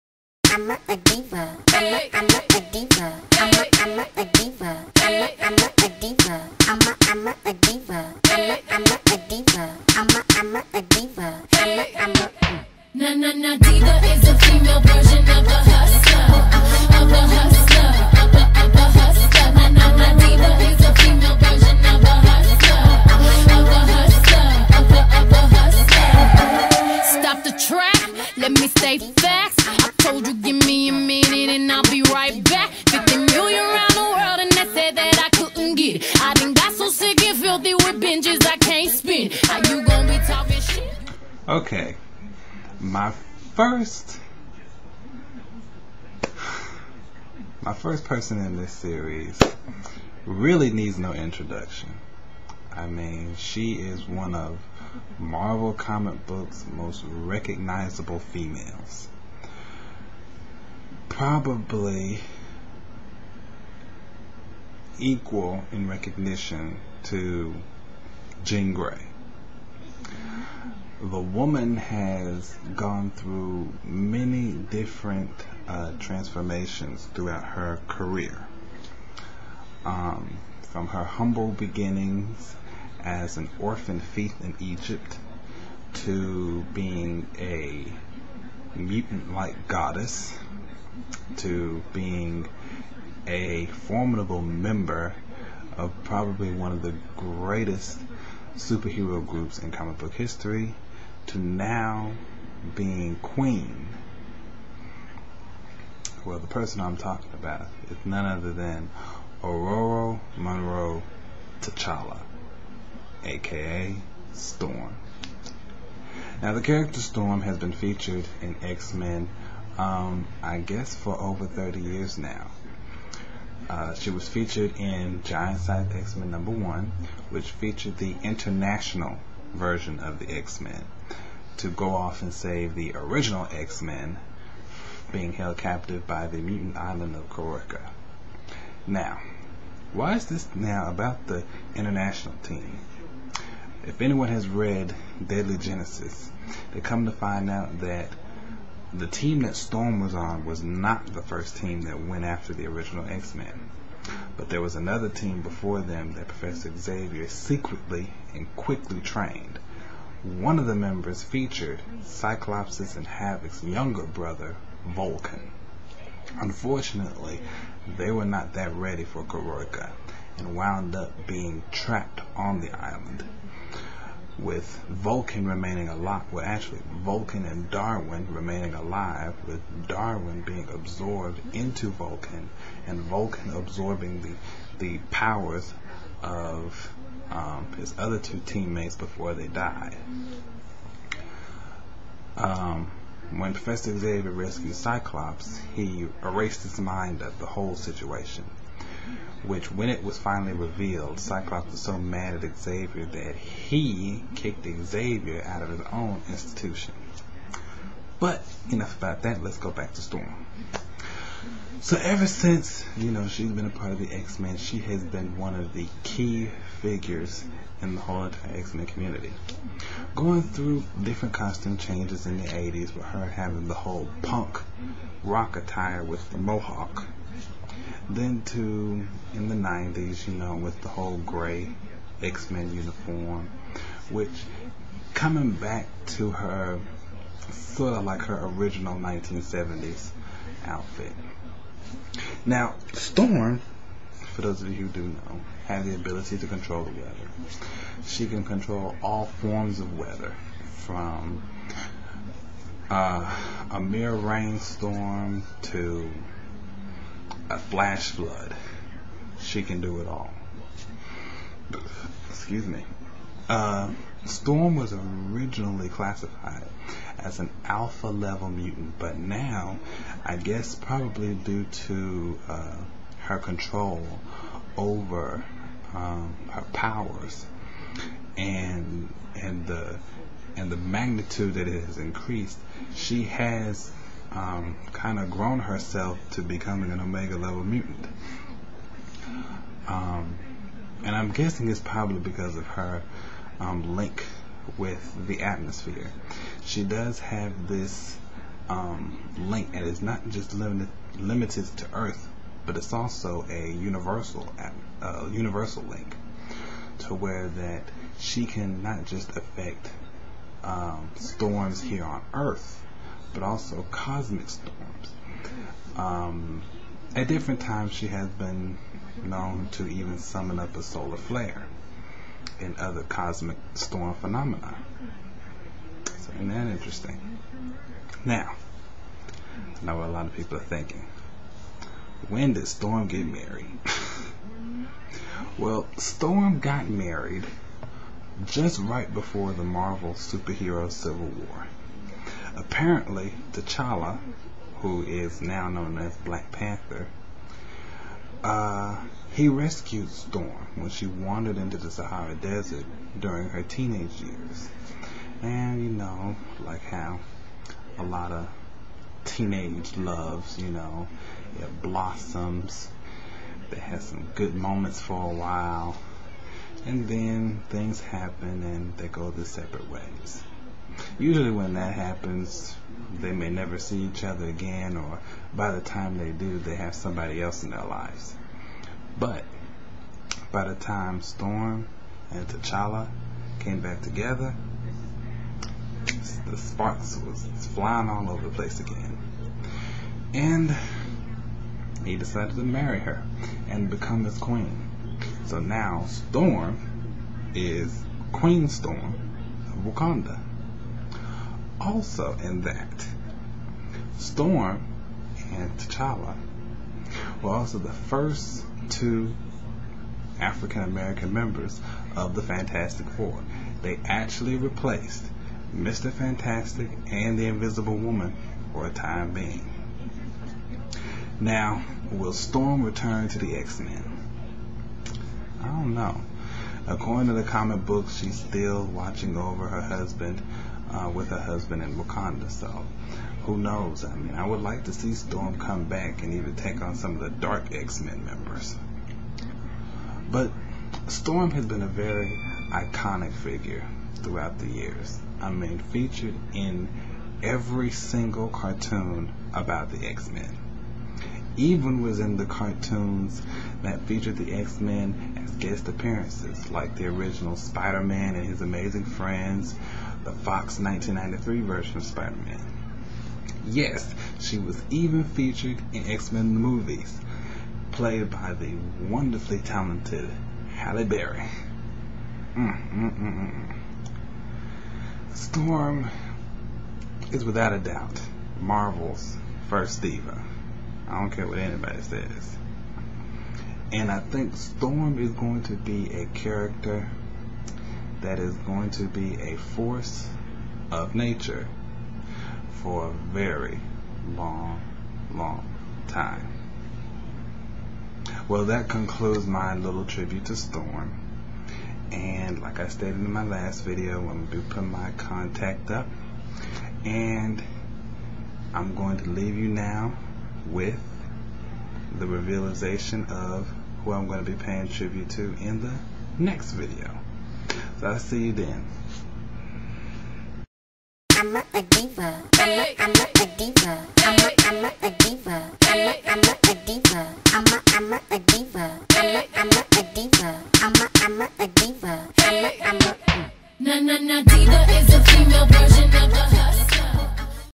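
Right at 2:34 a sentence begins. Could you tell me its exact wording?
But there was another team before them that Professor Xavier secretly and quickly trained.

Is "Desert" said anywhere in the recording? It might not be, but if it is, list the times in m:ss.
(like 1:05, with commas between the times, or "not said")
5:52.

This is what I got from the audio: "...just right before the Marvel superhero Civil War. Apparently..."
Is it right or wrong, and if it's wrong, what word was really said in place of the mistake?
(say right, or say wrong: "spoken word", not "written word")
right.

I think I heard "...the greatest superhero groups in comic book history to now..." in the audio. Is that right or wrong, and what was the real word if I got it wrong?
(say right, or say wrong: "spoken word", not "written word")
right.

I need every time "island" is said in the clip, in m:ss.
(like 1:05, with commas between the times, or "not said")
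2:16, 2:52.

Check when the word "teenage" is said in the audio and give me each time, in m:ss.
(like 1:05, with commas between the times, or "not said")
5:53, 5:59.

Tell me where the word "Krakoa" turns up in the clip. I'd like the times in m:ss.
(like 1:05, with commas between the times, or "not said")
2:17, 2:49.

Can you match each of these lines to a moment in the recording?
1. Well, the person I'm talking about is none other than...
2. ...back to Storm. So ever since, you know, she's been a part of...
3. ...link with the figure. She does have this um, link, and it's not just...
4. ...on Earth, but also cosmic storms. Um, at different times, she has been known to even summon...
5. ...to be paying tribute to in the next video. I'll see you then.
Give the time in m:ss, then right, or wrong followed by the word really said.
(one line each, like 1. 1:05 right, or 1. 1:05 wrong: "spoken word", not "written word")
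1. 1:46 right
2. 3:29 right
3. 4:53 wrong: "atmosphere", not "figure"
4. 5:12 right
5. 8:34 right.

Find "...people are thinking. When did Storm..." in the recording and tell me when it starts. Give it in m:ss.
5:30.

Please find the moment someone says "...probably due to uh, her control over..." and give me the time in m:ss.
4:30.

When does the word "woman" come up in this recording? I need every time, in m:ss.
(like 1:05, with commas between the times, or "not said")
1:11, 6:57.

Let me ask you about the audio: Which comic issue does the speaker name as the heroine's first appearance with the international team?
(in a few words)
Giant Size X Men number 1.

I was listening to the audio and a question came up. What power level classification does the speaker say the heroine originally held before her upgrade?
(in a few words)
Alpha level.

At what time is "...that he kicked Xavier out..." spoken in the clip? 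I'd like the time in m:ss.
3:23.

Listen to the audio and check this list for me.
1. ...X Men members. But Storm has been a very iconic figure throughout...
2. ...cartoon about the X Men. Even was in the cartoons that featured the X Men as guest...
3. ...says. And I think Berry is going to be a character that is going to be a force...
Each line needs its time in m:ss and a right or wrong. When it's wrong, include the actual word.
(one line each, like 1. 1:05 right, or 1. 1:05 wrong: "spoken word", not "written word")
1. 7:17 right
2. 7:28 right
3. 8:02 wrong: "Storm", not "Berry".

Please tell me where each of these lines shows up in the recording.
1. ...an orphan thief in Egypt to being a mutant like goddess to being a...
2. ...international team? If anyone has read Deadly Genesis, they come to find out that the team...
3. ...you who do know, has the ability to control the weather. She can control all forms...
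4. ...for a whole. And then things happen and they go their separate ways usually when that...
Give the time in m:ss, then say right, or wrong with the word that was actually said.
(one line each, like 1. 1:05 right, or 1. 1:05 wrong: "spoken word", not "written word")
1. 1:23 right
2. 2:21 right
3. 4:04 right
4. 6:04 wrong: "while", not "whole".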